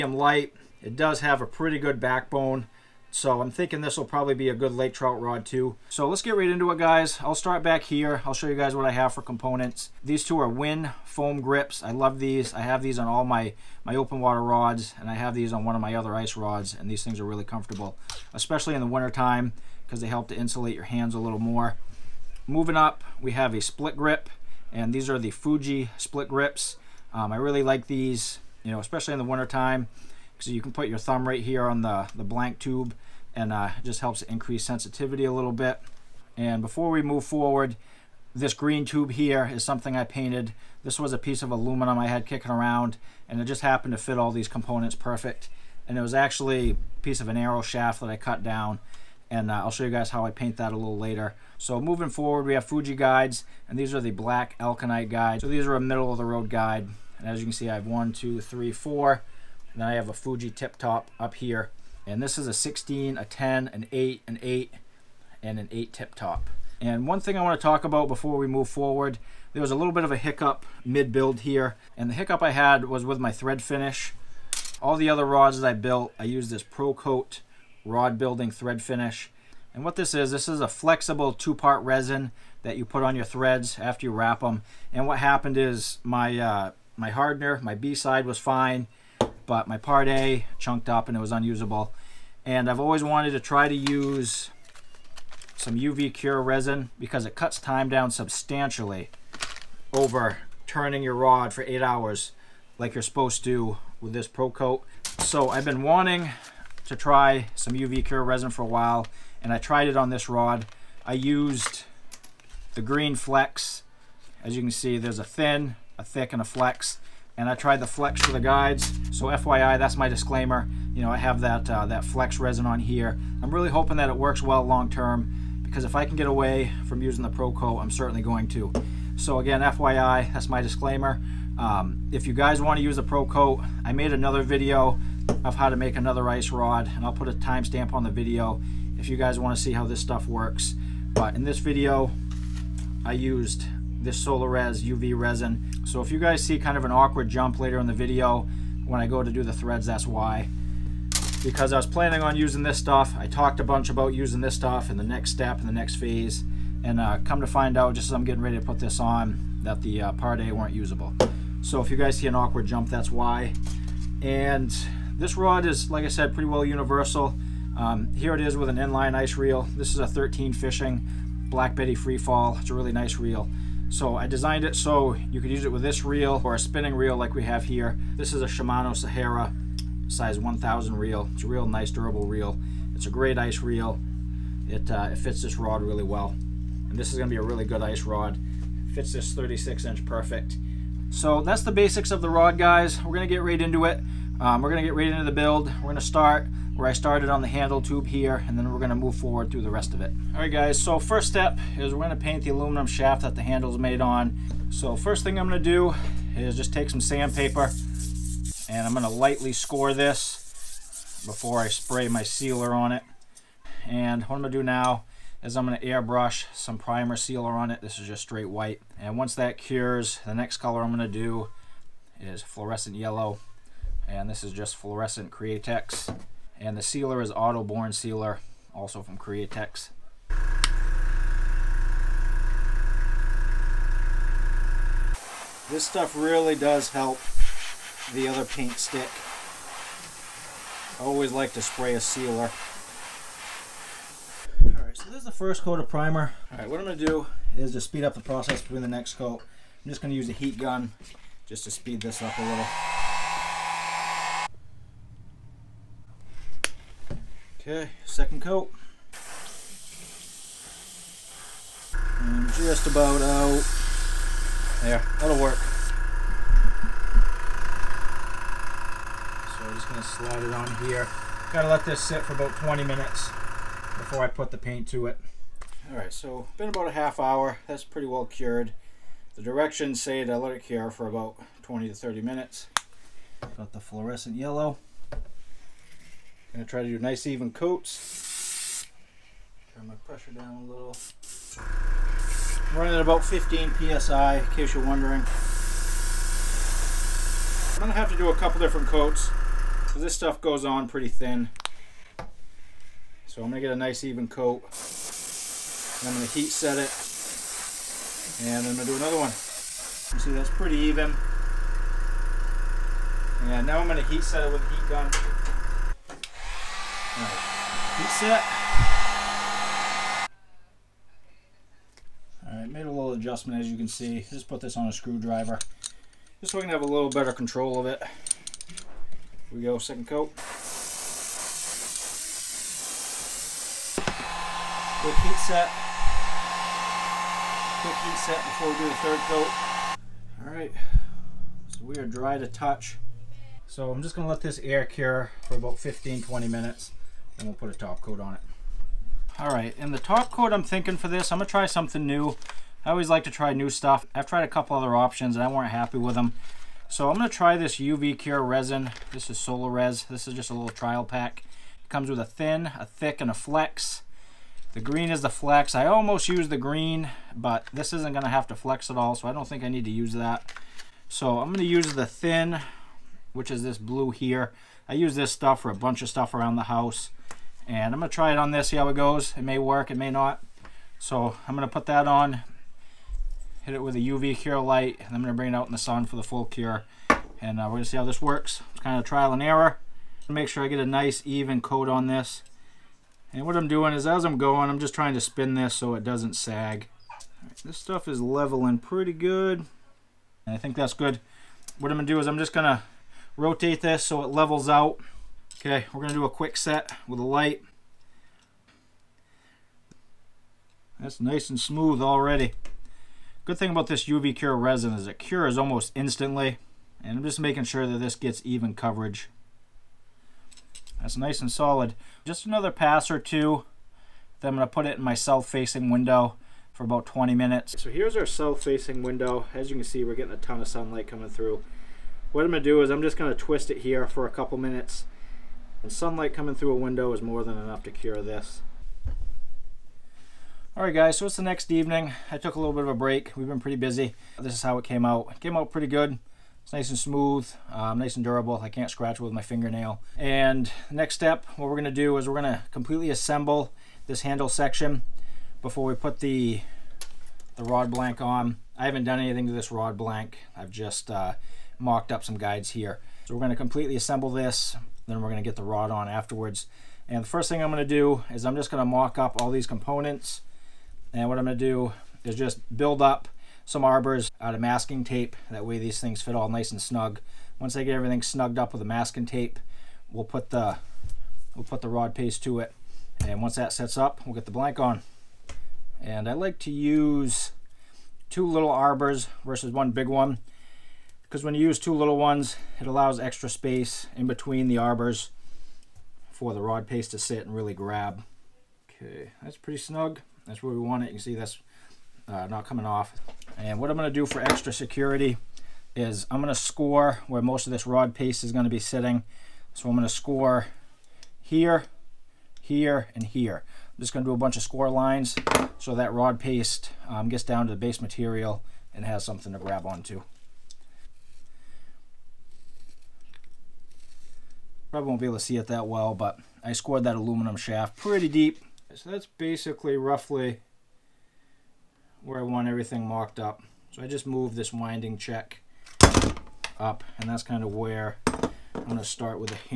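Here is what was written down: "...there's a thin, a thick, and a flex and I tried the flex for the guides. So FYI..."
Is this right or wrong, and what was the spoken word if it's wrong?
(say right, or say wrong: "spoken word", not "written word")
right.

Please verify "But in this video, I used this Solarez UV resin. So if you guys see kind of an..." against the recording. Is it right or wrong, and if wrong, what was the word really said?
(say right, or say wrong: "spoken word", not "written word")
right.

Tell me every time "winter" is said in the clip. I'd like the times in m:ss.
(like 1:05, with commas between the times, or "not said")
0:18, 0:29.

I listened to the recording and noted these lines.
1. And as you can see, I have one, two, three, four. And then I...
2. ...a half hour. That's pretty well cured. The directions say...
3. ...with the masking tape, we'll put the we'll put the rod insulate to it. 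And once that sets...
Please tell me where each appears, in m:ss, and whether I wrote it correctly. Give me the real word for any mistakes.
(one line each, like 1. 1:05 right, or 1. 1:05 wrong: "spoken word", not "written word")
1. 0:57 right
2. 4:36 right
3. 7:58 wrong: "paste", not "insulate".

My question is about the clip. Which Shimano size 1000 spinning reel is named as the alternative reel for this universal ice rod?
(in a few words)
Sahara.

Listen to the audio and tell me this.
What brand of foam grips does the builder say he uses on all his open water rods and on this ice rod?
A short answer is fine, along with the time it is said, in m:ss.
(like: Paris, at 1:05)
Winn, at 0:10.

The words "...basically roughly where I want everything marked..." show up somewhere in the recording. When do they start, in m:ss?
8:49.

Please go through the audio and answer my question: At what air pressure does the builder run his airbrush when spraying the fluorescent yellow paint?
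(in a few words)
15 psi.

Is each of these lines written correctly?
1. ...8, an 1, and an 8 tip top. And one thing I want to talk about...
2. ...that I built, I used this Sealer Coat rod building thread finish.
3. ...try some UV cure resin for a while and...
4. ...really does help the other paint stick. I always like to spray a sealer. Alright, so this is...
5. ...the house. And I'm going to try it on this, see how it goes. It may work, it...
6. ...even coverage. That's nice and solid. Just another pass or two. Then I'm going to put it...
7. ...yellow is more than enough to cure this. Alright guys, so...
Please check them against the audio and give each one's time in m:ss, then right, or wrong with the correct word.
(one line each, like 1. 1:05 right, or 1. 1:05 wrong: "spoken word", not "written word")
1. 1:03 wrong: "8", not "1"
2. 1:15 wrong: "Pro", not "Sealer"
3. 1:46 right
4. 3:56 right
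5. 6:16 right
6. 6:58 right
7. 7:16 wrong: "window", not "yellow".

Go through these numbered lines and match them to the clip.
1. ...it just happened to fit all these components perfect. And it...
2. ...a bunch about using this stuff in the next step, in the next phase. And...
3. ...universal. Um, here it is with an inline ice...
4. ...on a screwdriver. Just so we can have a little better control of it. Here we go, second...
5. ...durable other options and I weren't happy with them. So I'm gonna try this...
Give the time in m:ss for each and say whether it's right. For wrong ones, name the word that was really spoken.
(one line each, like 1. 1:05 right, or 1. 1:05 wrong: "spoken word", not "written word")
1. 0:43 right
2. 2:33 right
3. 2:46 right
4. 5:24 right
5. 5:54 wrong: "couple", not "durable".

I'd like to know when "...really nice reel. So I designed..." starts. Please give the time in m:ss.
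2:52.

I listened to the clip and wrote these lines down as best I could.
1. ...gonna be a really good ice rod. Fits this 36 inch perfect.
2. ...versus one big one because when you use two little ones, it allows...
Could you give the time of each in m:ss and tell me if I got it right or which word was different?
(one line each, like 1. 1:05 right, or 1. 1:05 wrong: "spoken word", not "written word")
1. 3:07 right
2. 8:09 right.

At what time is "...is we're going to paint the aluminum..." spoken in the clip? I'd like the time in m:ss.
3:21.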